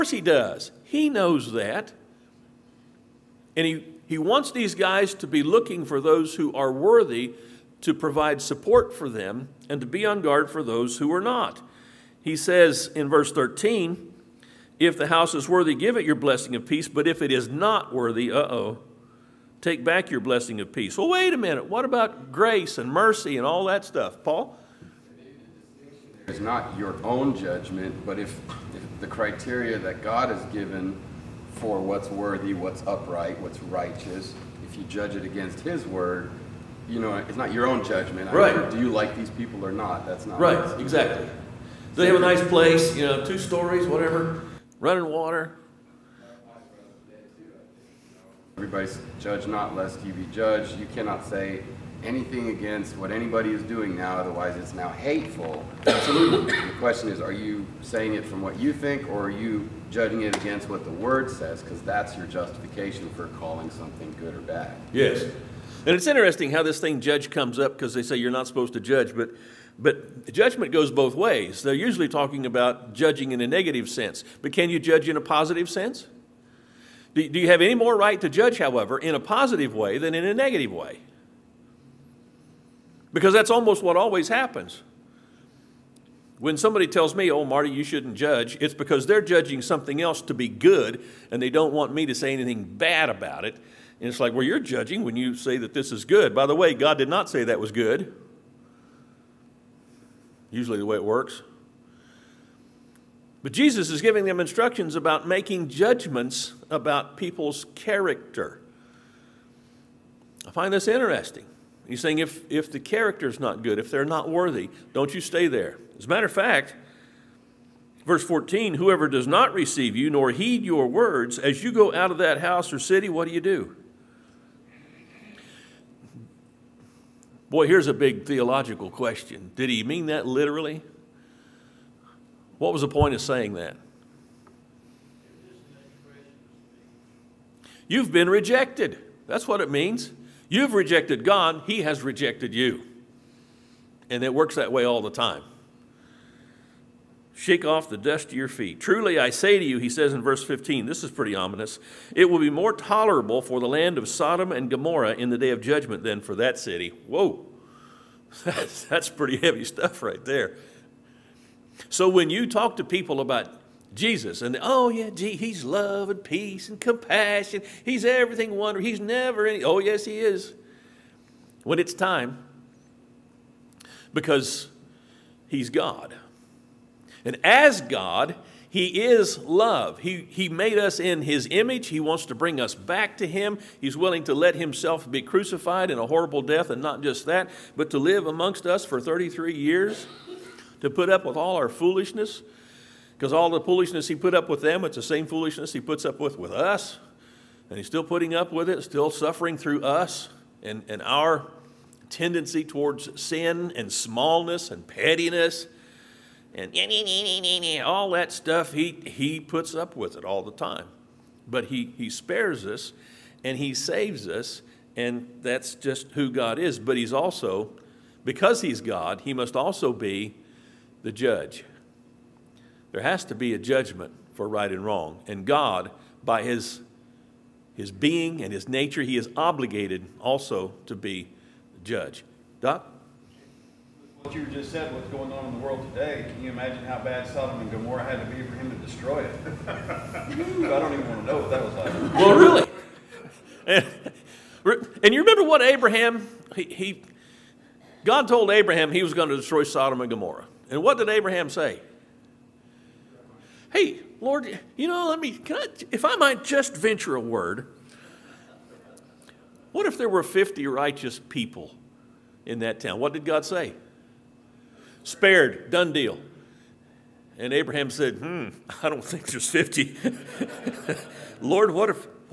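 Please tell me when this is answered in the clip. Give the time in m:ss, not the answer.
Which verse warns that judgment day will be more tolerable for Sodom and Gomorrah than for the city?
2:30.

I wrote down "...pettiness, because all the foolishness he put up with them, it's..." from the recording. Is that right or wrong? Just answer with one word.
wrong.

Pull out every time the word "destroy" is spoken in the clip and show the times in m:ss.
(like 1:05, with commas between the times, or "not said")
3:58, 4:09.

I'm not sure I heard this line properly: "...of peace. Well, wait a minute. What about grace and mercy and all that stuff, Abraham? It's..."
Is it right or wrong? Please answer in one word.
wrong.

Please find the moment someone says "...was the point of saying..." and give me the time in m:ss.
2:12.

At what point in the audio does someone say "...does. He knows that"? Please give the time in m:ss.
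0:00.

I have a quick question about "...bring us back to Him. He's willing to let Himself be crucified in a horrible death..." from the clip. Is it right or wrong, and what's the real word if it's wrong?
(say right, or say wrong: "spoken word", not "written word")
right.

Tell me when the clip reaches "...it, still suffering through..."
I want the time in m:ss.
3:18.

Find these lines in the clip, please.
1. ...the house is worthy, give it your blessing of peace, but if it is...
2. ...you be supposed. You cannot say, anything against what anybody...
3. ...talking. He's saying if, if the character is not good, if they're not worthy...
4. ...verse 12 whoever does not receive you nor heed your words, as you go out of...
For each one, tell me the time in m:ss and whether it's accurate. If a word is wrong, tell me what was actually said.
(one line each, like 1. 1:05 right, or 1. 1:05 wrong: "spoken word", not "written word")
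1. 0:14 right
2. 0:50 wrong: "judged", not "supposed"
3. 1:50 wrong: "interesting", not "talking"
4. 1:58 wrong: "14", not "12".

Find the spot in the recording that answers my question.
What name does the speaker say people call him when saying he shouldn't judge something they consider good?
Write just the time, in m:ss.
1:27.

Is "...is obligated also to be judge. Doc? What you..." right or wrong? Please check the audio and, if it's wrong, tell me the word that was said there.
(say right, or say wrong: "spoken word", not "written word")
right.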